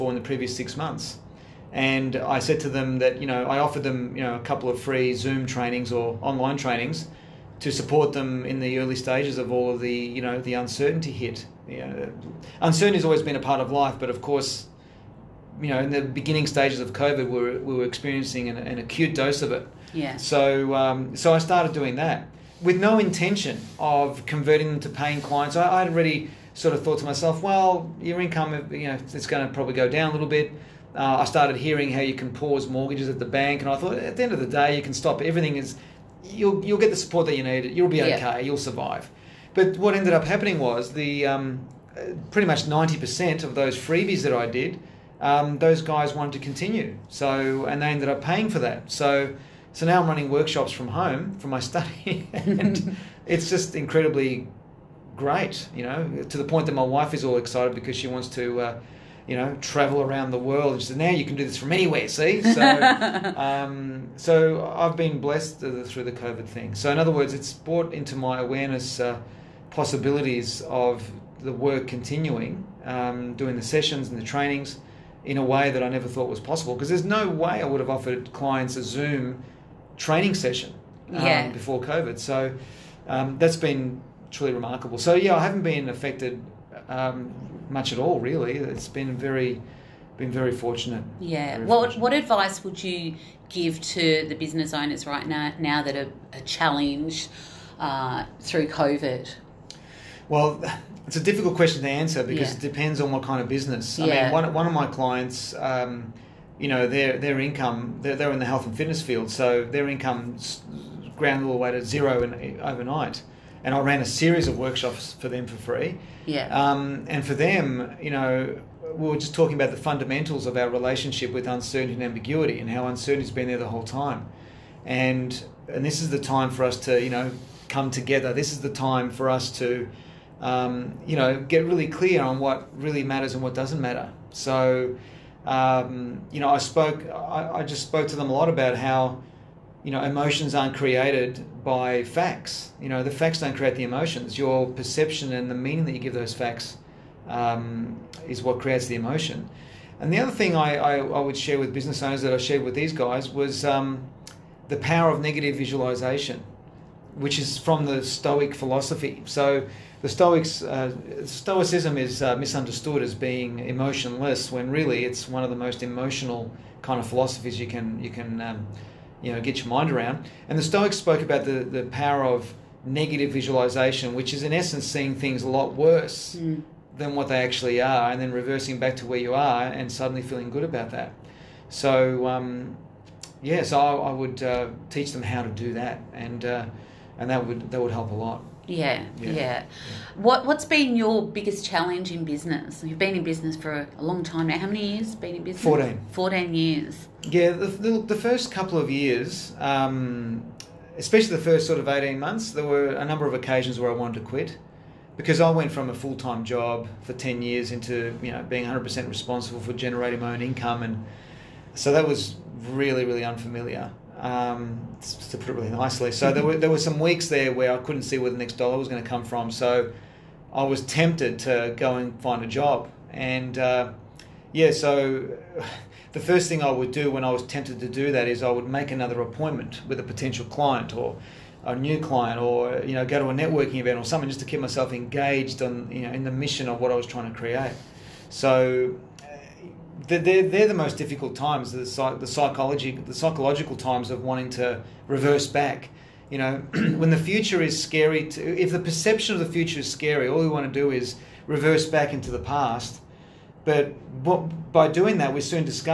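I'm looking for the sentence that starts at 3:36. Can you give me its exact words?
So there were there were some weeks there where I couldn't see where the next dollar was going to come from.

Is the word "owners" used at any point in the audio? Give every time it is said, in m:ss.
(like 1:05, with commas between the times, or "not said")
1:34, 2:32.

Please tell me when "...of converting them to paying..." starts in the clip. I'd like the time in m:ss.
0:23.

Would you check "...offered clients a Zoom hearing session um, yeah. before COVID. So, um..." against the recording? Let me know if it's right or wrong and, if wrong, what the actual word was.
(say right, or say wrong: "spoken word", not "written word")
wrong: "training", not "hearing".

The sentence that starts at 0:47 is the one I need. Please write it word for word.
So and they ended up paying for that.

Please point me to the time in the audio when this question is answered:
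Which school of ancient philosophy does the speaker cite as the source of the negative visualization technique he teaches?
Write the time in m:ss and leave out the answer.
2:38.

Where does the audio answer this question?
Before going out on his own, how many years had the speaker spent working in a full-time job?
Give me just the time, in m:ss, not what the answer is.
3:27.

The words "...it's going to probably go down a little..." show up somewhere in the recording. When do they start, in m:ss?
0:29.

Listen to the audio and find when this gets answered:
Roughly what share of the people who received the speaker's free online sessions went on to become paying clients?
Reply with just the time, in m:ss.
0:42.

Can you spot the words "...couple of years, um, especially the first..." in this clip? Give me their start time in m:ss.
3:18.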